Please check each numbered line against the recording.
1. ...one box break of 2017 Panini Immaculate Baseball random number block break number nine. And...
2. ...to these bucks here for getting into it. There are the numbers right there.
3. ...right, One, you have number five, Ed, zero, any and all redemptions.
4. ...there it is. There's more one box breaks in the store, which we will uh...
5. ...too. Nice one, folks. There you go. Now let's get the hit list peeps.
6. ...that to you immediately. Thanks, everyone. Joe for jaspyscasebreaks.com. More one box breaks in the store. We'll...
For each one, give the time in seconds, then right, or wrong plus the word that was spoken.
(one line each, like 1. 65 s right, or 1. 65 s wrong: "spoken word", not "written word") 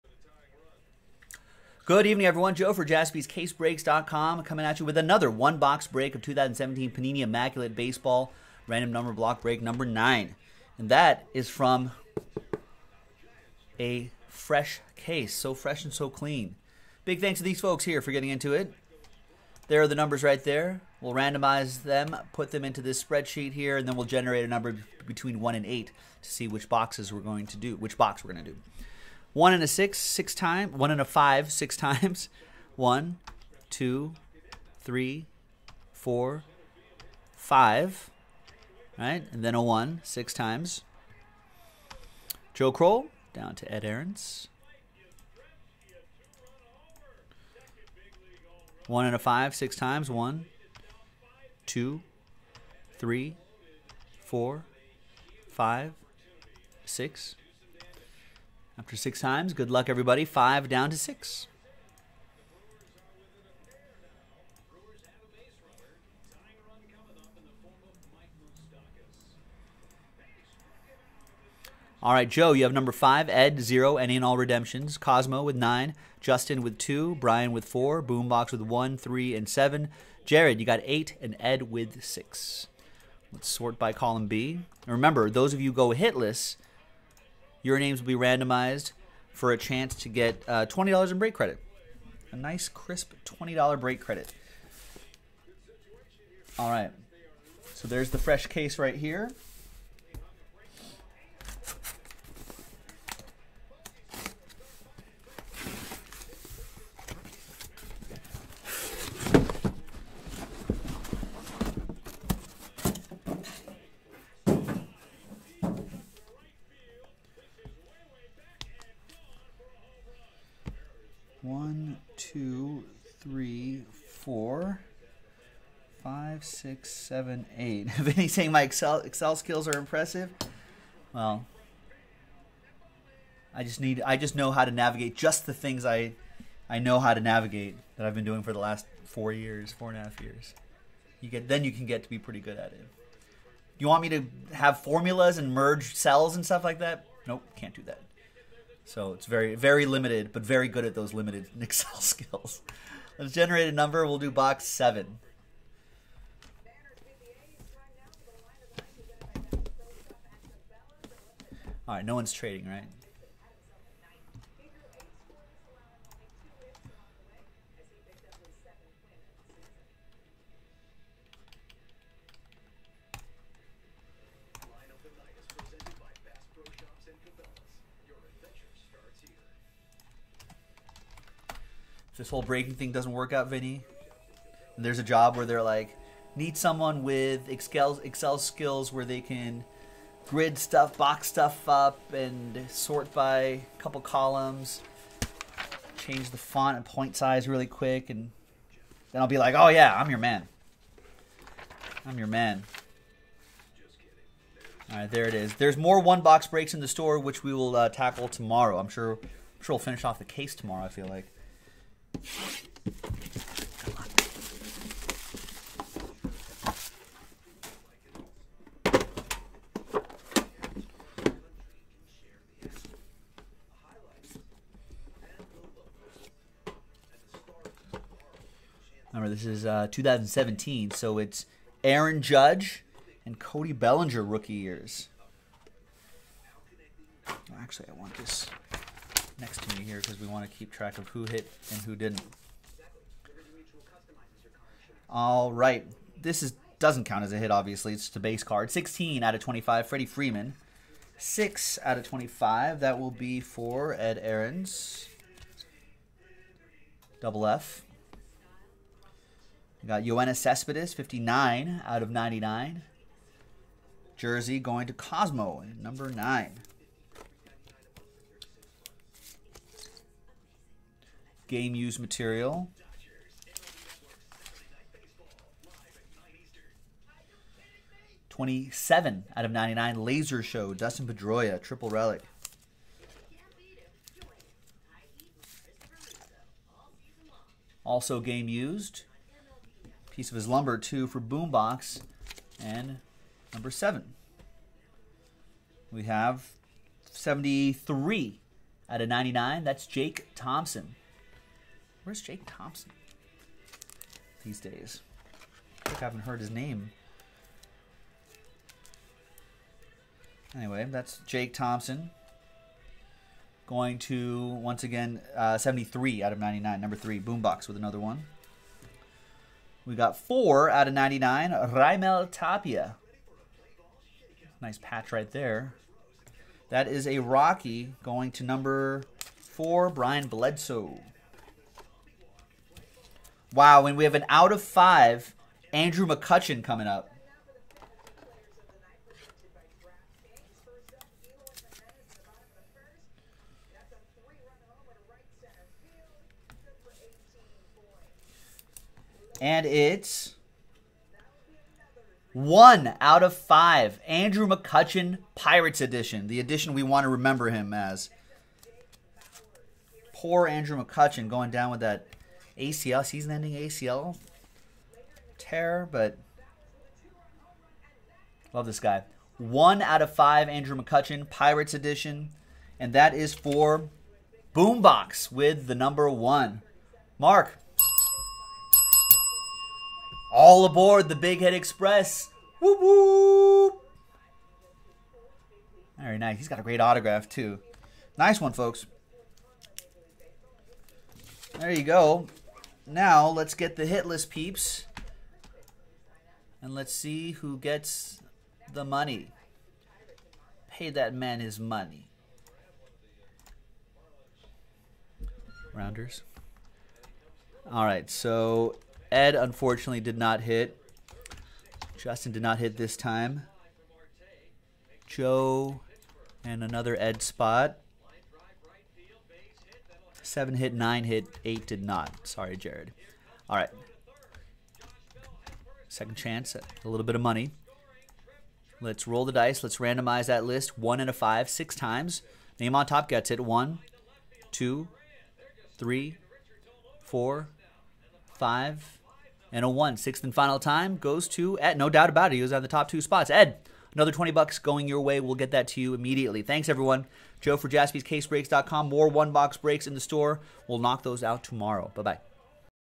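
1. 5 s right
2. 17 s wrong: "folks", not "bucks"
3. 72 s wrong: "Joe", not "One"
4. 205 s right
5. 387 s right
6. 445 s right.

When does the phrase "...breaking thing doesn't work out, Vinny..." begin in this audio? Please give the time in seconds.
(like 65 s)
182 s.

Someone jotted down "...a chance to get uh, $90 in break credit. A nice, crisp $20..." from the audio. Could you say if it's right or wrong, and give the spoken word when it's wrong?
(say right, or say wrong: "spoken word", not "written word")
wrong: "20", not "90".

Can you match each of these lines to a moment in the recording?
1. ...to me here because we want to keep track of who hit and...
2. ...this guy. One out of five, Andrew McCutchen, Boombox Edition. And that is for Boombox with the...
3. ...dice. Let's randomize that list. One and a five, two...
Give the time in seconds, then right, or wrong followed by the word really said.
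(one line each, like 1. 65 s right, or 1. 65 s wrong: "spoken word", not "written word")
1. 239 s right
2. 368 s wrong: "Pirates", not "Boombox"
3. 429 s wrong: "six", not "two".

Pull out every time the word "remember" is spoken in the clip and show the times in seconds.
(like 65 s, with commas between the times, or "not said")
84 s, 229 s, 357 s.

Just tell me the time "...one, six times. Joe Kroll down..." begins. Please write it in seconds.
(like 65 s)
39 s.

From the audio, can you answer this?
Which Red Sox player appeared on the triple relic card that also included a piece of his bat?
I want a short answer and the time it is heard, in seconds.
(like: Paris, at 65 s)
Dustin Pedroia, at 280 s.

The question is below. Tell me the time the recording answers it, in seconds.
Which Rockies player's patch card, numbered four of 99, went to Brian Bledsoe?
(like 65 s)
321 s.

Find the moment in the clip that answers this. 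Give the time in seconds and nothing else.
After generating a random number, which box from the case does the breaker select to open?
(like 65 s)
154 s.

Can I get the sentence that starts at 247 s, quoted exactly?
Obviously, it's just a base card.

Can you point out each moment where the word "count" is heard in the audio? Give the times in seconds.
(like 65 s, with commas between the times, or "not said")
247 s.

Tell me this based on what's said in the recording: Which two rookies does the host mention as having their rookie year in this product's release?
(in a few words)
Aaron Judge and Cody Bellinger.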